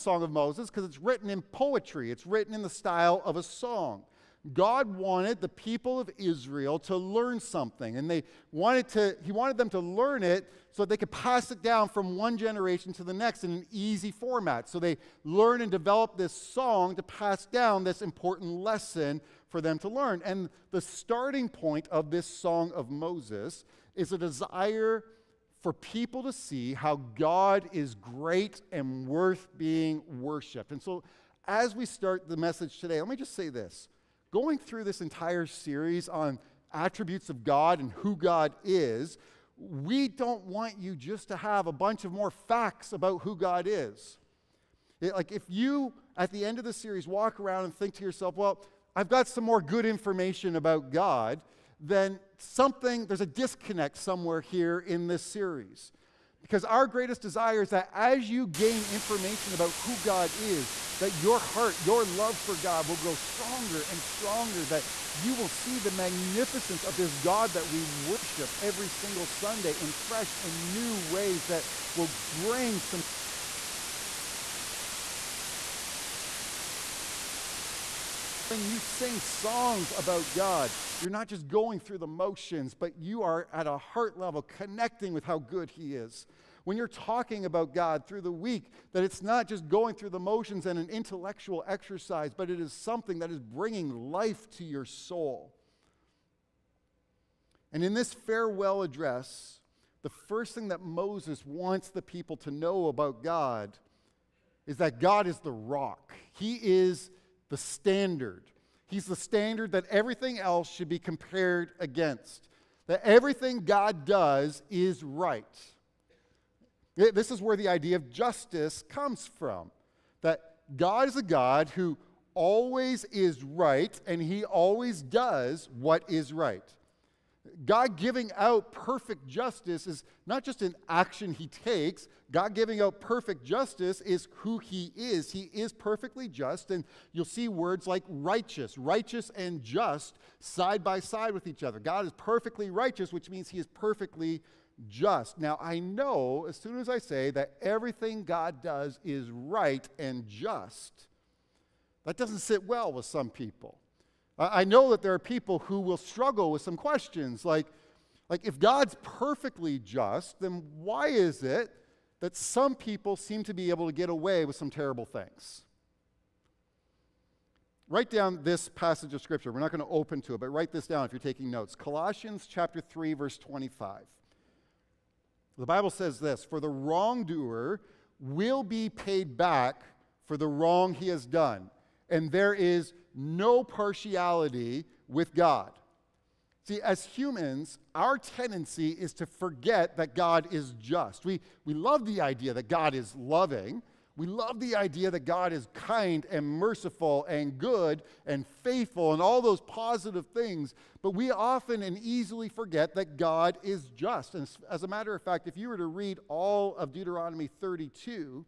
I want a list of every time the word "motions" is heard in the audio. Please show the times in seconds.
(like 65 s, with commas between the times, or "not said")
82 s, 90 s.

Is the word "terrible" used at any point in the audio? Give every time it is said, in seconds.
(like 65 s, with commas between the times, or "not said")
164 s.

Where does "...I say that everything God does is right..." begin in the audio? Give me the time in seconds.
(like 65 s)
146 s.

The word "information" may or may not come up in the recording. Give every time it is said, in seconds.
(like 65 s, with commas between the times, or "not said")
49 s, 58 s.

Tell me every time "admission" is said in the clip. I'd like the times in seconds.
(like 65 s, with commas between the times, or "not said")
not said.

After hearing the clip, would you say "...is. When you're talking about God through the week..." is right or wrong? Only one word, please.
right.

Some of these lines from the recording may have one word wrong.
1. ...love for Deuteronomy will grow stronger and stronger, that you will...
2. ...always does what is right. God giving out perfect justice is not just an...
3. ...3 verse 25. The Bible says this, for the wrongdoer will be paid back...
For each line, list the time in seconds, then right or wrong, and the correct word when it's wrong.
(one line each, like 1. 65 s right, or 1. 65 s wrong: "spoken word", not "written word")
1. 62 s wrong: "God", not "Deuteronomy"
2. 124 s right
3. 172 s right.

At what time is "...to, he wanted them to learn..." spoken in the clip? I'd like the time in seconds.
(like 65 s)
8 s.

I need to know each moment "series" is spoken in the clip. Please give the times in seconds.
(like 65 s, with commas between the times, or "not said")
35 s, 46 s, 55 s.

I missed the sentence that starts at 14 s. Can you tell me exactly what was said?
So they learn and develop this song to pass down this important lesson for them to learn.